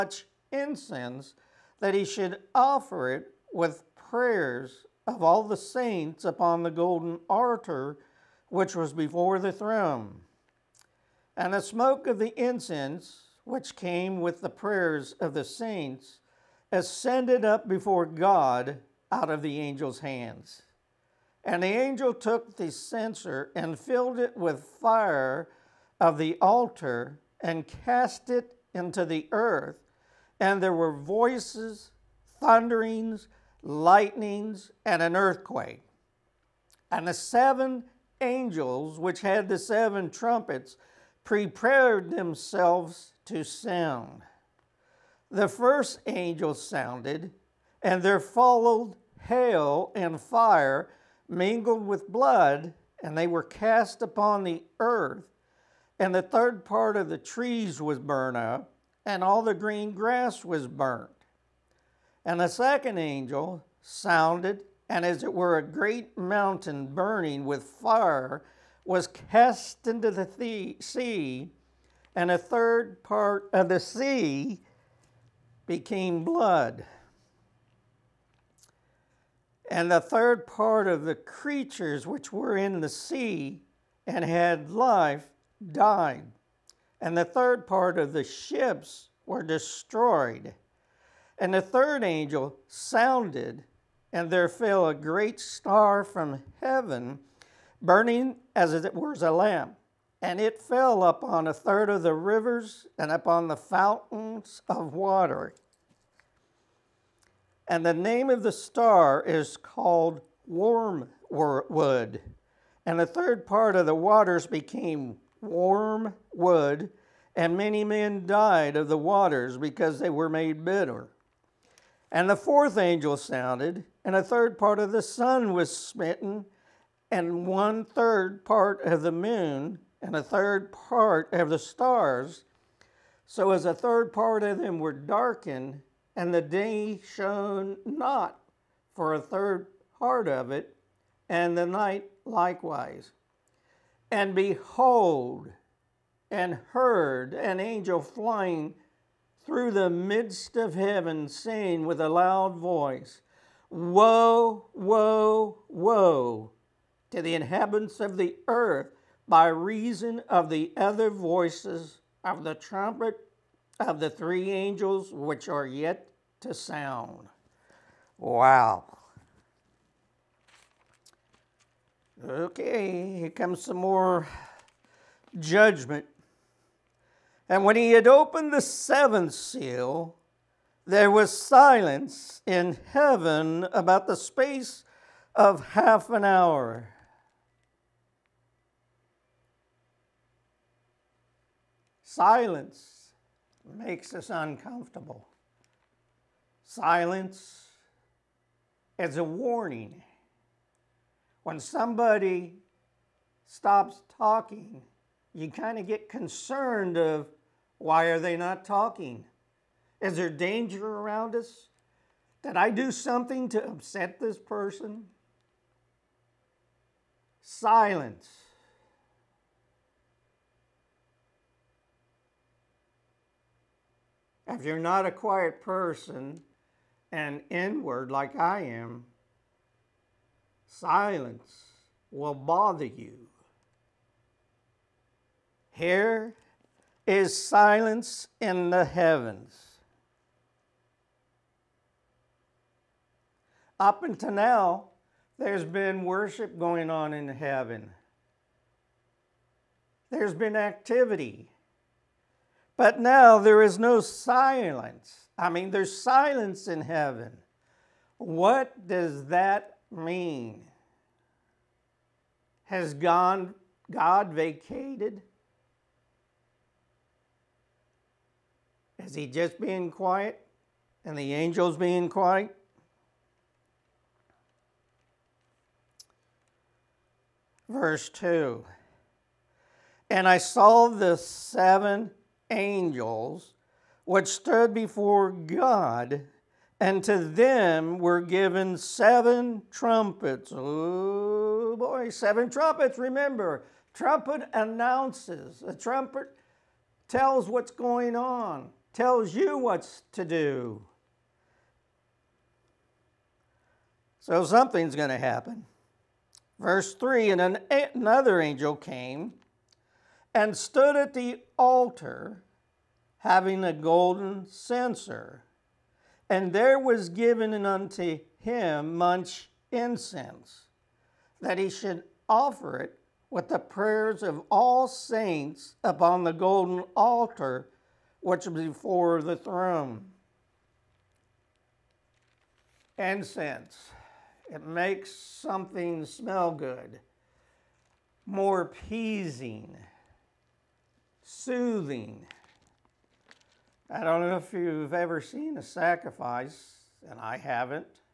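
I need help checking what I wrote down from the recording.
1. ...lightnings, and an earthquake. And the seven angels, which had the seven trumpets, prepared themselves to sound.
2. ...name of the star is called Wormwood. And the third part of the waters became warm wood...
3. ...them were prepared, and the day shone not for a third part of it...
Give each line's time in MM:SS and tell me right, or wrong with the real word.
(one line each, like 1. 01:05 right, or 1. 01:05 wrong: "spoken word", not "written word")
1. 00:33 right
2. 01:47 right
3. 02:14 wrong: "darkened", not "prepared".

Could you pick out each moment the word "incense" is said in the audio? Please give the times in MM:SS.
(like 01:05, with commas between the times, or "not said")
00:00, 00:12, 05:19, 05:32.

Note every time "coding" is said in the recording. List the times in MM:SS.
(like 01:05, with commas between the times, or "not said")
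not said.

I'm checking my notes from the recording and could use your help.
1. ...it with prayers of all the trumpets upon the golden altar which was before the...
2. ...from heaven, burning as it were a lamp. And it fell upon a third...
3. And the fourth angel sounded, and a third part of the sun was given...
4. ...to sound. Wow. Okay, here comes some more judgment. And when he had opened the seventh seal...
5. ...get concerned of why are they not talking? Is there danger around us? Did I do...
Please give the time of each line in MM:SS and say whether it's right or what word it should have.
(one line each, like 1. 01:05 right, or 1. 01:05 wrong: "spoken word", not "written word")
1. 00:03 wrong: "saints", not "trumpets"
2. 01:36 right
3. 02:02 wrong: "smitten", not "given"
4. 02:46 right
5. 03:25 right.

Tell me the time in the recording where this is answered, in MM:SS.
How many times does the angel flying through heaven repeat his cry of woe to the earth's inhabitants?
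02:33.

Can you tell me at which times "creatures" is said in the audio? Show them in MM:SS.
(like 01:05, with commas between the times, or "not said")
01:21.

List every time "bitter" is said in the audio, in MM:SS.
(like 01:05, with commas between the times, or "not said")
02:00.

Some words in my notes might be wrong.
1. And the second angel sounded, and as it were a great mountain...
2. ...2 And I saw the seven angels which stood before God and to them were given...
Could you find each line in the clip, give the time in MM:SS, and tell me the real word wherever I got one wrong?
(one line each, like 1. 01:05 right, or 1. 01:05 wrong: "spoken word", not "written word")
1. 01:02 right
2. 04:38 right.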